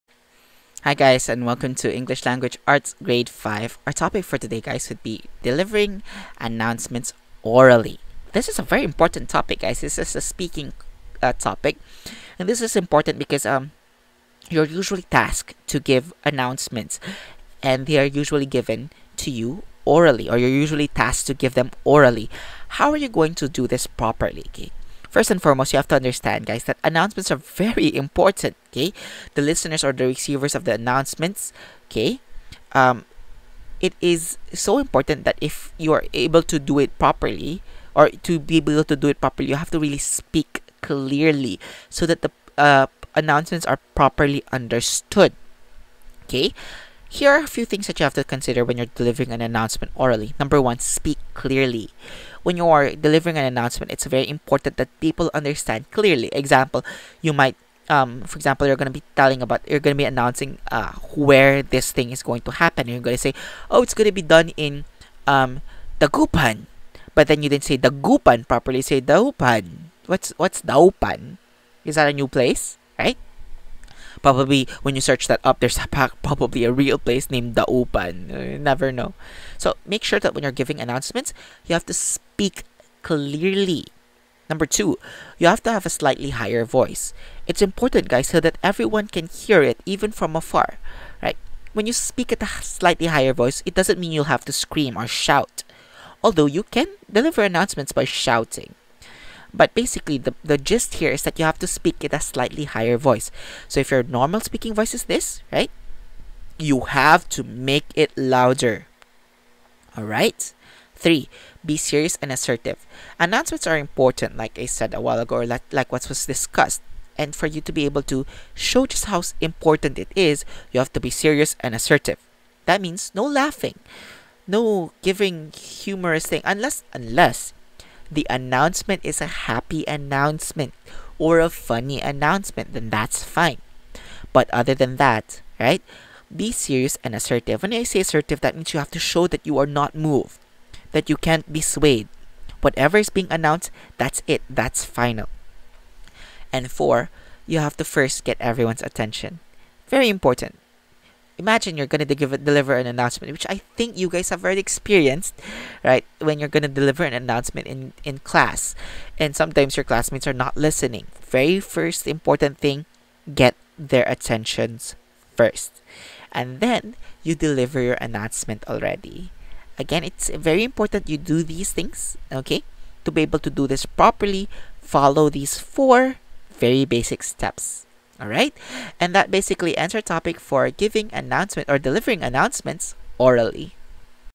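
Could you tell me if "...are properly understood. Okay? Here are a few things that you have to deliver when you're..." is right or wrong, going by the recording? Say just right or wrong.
wrong.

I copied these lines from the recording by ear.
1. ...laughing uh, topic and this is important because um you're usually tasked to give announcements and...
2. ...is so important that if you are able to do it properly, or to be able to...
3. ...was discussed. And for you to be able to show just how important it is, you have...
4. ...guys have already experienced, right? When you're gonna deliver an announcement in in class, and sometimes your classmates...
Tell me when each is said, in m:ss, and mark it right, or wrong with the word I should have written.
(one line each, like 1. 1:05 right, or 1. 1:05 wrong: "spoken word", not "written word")
1. 0:10 wrong: "speaking", not "laughing"
2. 0:33 right
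3. 1:56 right
4. 2:34 right.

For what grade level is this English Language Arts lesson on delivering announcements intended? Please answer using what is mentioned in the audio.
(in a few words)
Grade 5.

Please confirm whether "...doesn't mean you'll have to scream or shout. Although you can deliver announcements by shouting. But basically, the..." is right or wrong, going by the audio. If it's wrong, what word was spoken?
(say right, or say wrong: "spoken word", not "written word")
right.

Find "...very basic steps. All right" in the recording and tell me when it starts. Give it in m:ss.
2:56.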